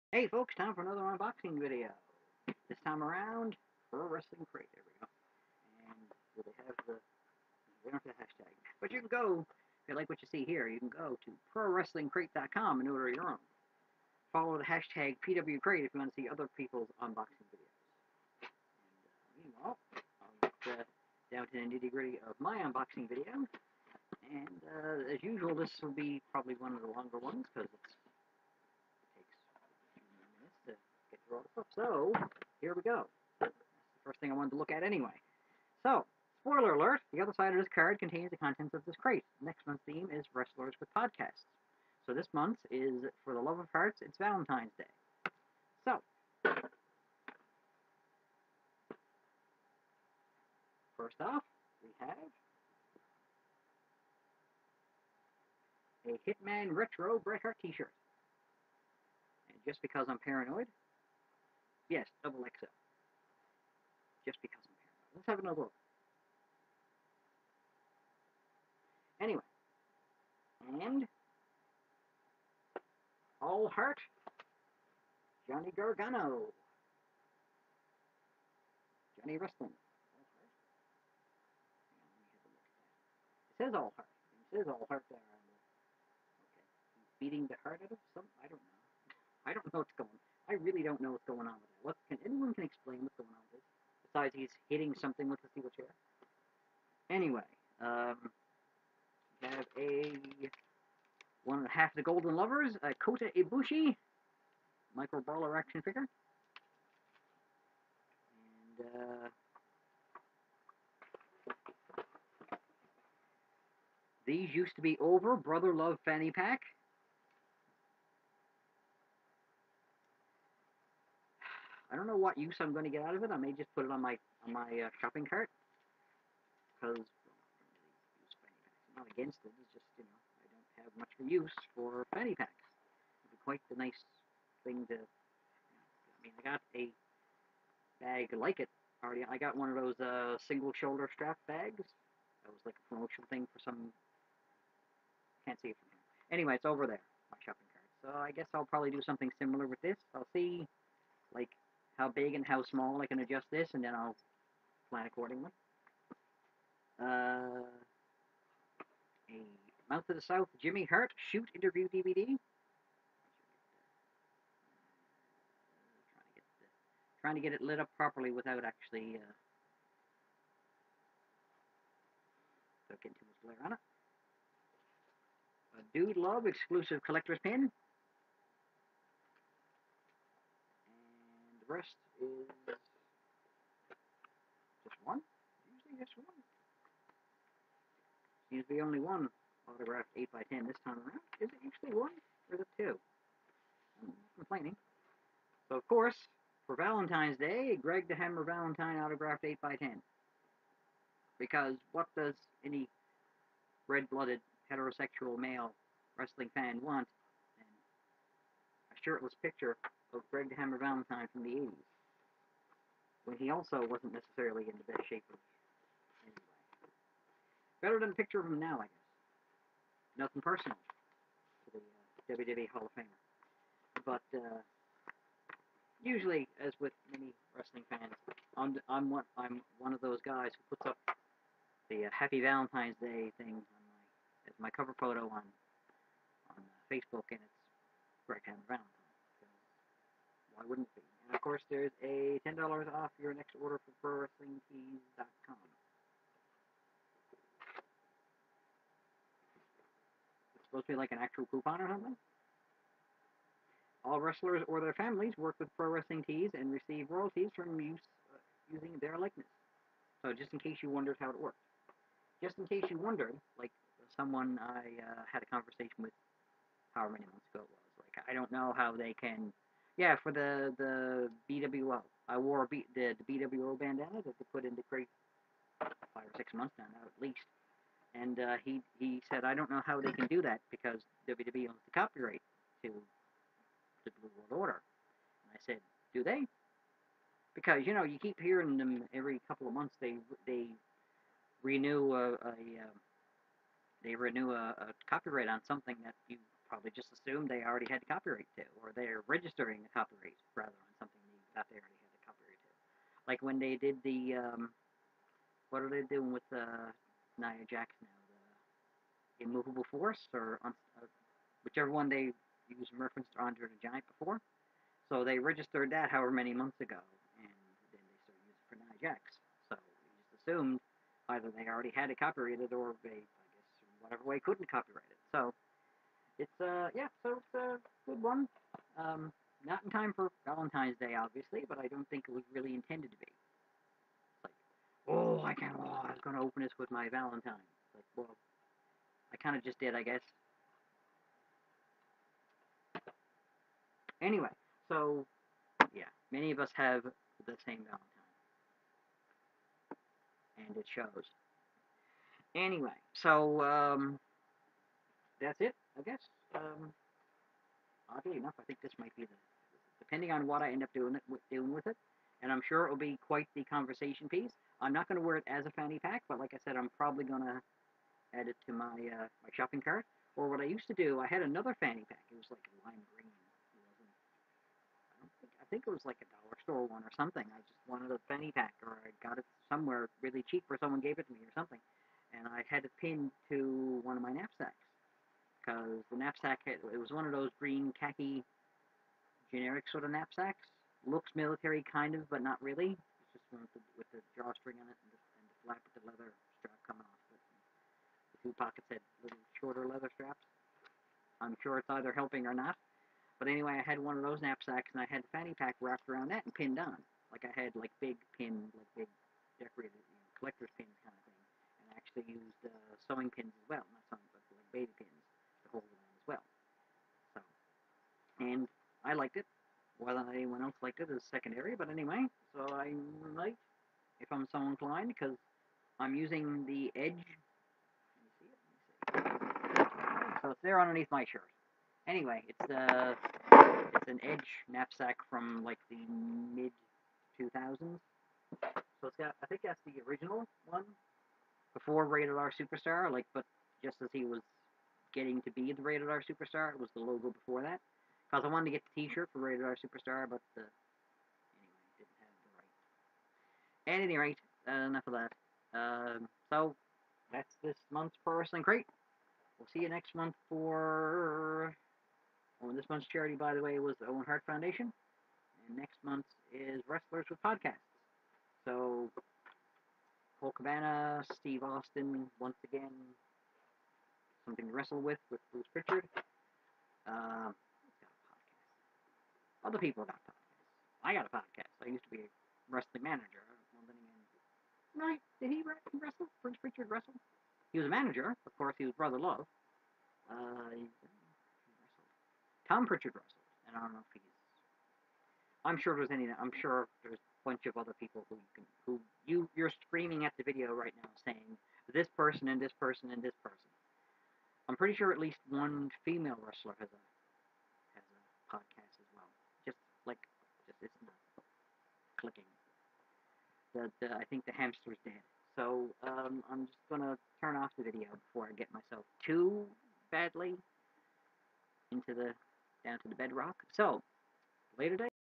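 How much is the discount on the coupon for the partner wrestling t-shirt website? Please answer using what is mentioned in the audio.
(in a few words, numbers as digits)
$10.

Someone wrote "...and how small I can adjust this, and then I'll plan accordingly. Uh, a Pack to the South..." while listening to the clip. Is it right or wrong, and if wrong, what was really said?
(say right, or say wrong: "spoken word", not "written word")
wrong: "Mouth", not "Pack".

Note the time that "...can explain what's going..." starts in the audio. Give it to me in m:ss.
1:32.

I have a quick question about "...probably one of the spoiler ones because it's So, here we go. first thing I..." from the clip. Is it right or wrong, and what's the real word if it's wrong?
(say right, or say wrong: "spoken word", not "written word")
wrong: "longer", not "spoiler".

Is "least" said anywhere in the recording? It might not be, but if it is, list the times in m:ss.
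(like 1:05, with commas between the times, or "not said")
4:37, 8:25.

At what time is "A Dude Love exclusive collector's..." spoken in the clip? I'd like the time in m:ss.
2:55.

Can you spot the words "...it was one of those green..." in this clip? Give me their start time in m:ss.
6:26.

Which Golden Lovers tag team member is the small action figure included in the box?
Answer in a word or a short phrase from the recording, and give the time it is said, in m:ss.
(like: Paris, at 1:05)
Kota Ibushi, at 1:42.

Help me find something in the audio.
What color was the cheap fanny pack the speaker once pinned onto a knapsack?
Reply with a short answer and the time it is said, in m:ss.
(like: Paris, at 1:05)
lime green, at 6:12.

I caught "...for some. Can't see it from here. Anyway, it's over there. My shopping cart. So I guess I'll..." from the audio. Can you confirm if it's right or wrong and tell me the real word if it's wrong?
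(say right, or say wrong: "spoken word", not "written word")
right.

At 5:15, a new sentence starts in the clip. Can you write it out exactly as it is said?
So they registered that however many months ago, and then they started using it for Nia Jax.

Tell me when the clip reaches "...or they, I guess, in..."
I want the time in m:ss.
5:22.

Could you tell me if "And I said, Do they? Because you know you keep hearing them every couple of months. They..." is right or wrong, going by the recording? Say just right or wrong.
right.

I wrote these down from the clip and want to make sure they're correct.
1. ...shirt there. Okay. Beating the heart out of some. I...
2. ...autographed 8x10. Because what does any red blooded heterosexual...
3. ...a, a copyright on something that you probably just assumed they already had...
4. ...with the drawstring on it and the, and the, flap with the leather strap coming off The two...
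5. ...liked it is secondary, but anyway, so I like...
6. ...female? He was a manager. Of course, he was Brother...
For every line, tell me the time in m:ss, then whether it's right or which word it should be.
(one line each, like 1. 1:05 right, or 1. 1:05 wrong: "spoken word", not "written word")
1. 1:24 wrong: "heart", not "shirt"
2. 3:18 right
3. 4:54 right
4. 6:33 right
5. 7:00 right
6. 8:06 wrong: "wrestle", not "female".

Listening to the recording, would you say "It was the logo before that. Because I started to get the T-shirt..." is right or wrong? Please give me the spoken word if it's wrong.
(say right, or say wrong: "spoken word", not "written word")
wrong: "wanted", not "started".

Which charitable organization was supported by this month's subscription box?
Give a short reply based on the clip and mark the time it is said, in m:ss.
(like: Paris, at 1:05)
Owen Hart Foundation, at 7:44.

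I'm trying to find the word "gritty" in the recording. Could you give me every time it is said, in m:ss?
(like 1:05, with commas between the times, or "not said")
0:21.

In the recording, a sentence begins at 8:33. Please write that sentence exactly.
The, the I think the hamster's dead.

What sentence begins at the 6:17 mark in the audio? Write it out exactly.
I just wanted a fanny pack, or I got it somewhere really cheap, or someone gave it to me, or something.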